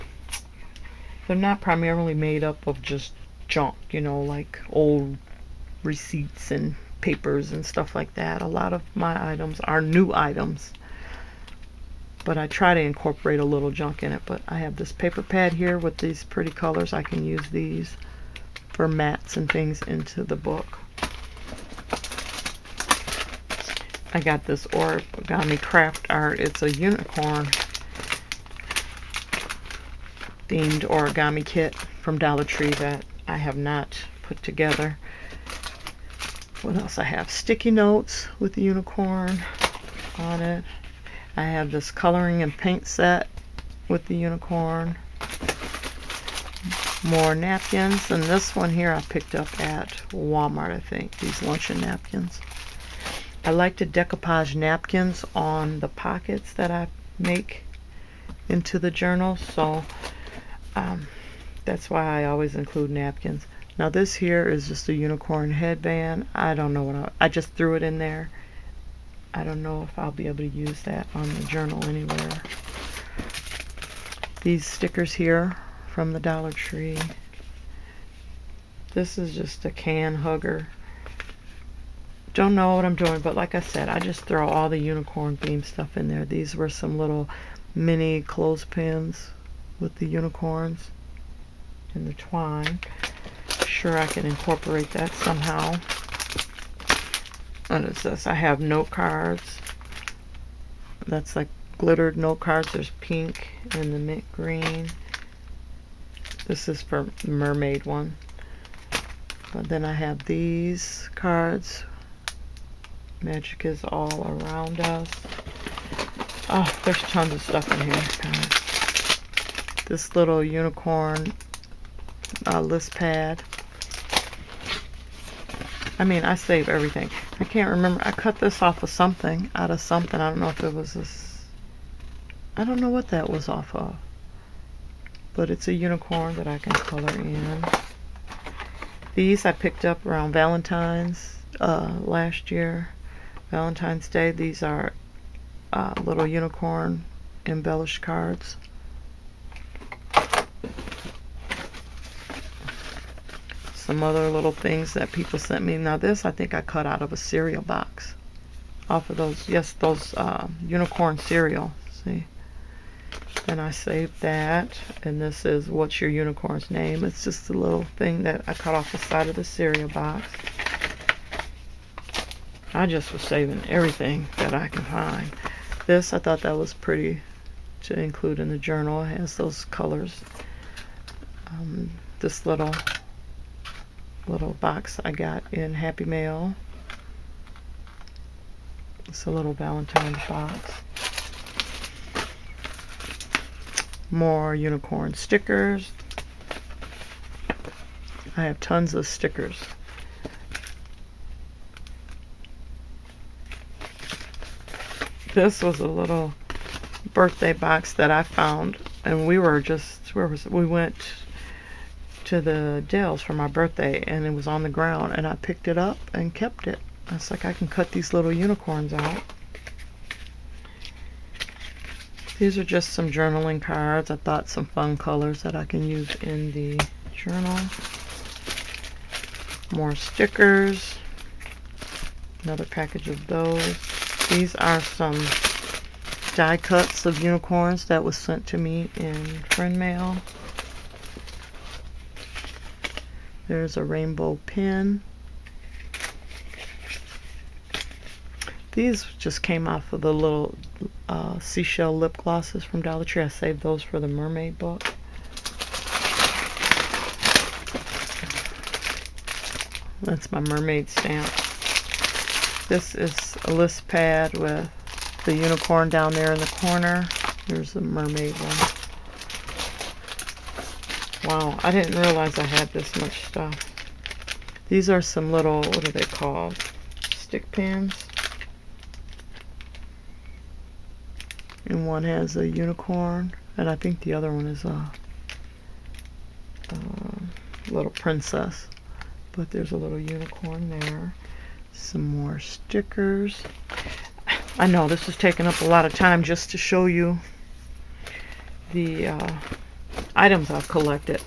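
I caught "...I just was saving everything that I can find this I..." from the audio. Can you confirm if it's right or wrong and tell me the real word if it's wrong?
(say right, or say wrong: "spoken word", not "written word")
right.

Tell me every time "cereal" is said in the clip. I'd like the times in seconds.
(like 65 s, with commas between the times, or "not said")
157 s, 161 s, 169 s.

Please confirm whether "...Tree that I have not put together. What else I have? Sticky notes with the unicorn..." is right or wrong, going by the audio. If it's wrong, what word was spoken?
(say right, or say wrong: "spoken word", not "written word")
right.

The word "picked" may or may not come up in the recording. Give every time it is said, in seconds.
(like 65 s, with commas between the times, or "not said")
49 s, 139 s, 215 s.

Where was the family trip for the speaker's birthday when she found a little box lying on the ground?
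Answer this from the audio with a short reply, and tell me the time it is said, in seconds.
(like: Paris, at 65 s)
The Dells, at 212 s.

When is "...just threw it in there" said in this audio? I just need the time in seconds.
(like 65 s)
67 s.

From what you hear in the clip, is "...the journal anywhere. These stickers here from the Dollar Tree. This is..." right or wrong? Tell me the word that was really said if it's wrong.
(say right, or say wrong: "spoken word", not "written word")
right.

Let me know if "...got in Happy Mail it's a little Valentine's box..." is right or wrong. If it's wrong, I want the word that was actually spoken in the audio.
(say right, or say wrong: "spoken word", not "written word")
right.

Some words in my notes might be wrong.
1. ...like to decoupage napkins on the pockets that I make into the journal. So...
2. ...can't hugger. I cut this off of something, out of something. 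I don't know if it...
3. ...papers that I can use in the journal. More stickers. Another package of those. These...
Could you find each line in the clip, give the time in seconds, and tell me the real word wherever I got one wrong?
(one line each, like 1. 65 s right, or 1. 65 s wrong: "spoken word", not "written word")
1. 53 s right
2. 127 s wrong: "remember", not "hugger"
3. 224 s wrong: "colors", not "papers".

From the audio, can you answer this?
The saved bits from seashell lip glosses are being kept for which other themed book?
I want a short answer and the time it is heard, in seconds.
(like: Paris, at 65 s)
Mermaid book, at 254 s.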